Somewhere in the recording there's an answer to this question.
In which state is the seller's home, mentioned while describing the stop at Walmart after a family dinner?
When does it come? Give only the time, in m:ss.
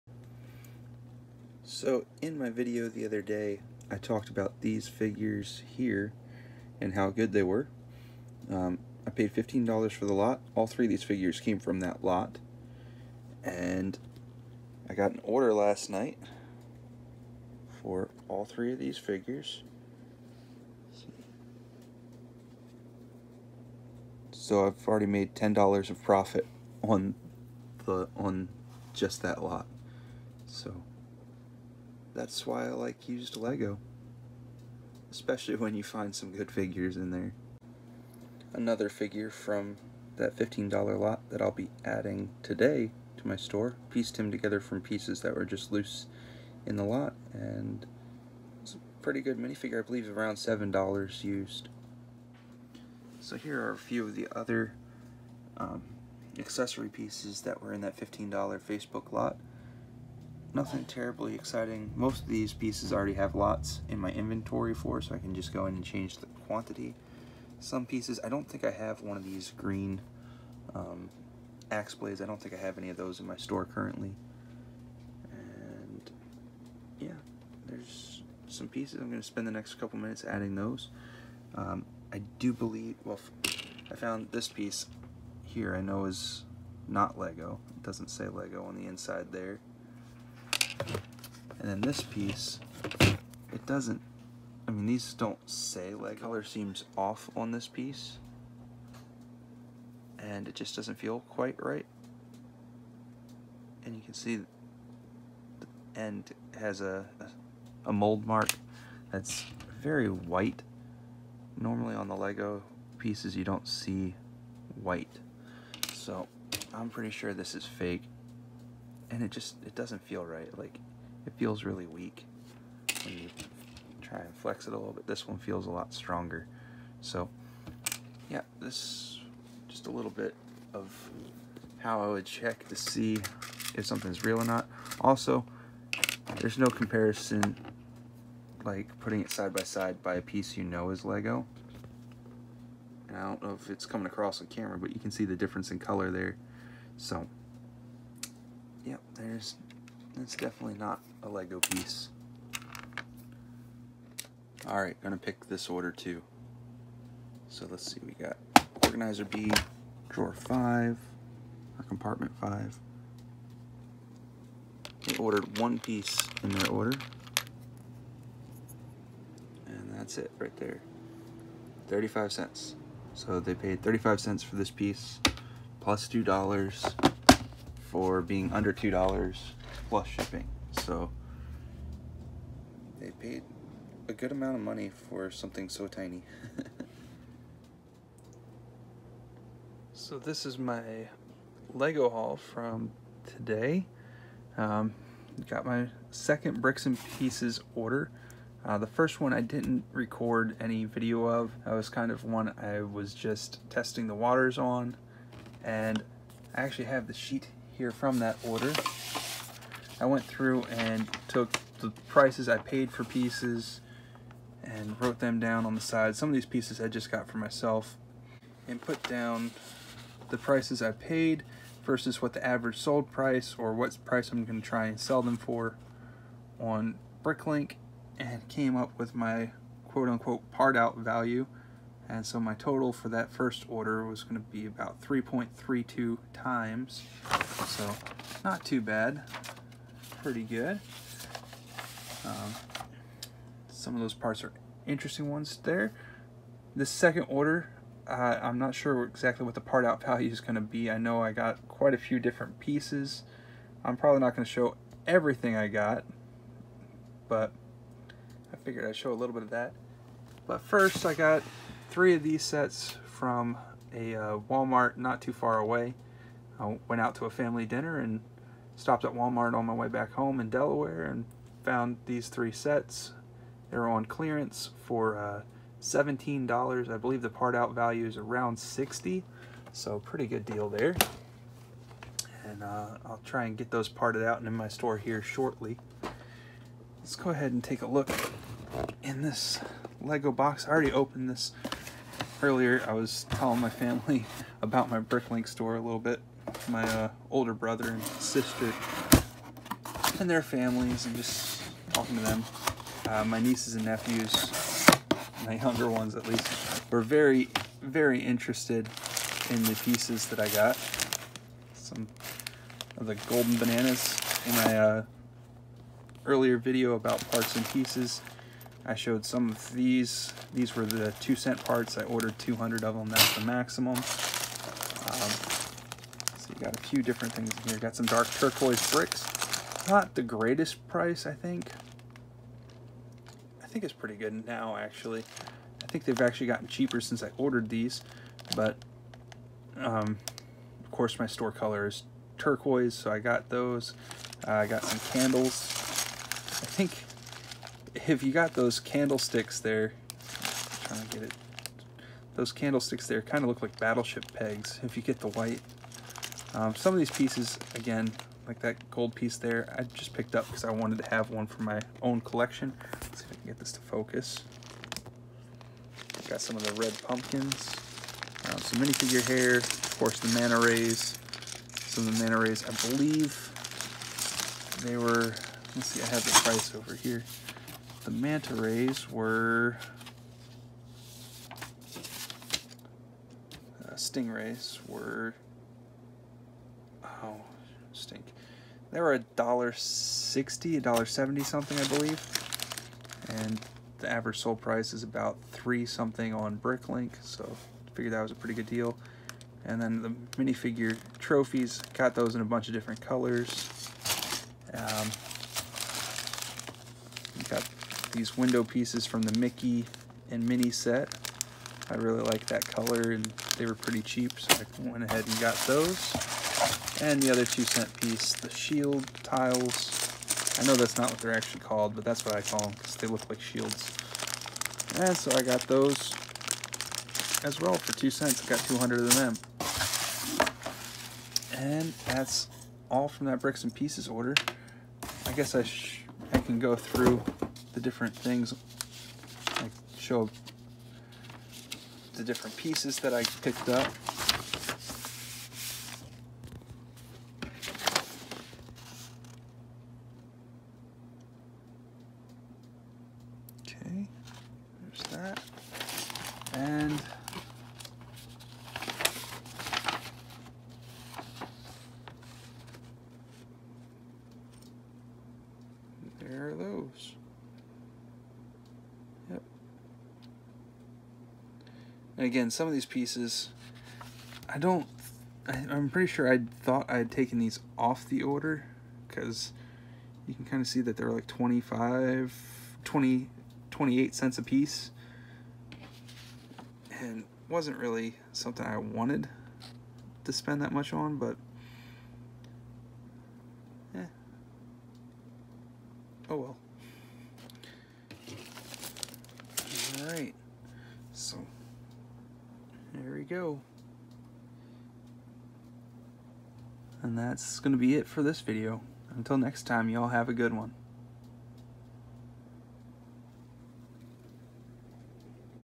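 4:30.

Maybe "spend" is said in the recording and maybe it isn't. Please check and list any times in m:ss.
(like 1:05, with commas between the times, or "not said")
1:19, 8:10.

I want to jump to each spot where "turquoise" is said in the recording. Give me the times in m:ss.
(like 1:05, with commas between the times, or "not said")
5:28, 5:42.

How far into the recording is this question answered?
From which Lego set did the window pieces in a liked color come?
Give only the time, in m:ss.
6:49.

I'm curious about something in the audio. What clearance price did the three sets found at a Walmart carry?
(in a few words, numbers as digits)
$17.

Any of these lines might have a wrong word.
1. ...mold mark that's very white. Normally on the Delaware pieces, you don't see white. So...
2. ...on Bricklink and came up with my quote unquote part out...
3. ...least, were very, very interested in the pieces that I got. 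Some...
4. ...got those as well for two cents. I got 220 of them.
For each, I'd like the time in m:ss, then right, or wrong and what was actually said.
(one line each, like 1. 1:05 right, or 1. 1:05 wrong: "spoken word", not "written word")
1. 1:47 wrong: "Lego", not "Delaware"
2. 3:46 right
3. 5:06 right
4. 7:05 wrong: "200", not "220".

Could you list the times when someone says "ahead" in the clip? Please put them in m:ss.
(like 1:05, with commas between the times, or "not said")
4:47, 6:55.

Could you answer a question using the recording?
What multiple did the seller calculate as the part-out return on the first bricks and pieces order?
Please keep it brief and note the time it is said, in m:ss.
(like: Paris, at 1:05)
3.32 times, at 3:55.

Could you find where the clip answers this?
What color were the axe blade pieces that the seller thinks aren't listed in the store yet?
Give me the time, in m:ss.
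1:09.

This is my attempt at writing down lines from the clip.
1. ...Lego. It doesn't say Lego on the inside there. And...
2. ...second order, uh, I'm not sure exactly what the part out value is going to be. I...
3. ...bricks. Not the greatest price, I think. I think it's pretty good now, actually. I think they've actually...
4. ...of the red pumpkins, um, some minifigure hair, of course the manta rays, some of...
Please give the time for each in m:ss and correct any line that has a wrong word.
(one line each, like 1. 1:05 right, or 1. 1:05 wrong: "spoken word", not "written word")
1. 1:27 right
2. 4:06 right
3. 5:28 right
4. 6:06 right.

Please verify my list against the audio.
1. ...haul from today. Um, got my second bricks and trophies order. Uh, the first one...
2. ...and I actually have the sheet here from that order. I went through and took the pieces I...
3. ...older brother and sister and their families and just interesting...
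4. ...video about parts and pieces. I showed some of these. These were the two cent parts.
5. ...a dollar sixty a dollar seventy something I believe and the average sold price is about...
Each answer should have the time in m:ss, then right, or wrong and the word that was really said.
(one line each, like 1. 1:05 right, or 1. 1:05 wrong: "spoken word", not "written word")
1. 3:12 wrong: "pieces", not "trophies"
2. 3:25 wrong: "prices", not "pieces"
3. 4:57 wrong: "talking", not "interesting"
4. 5:16 right
5. 6:29 right.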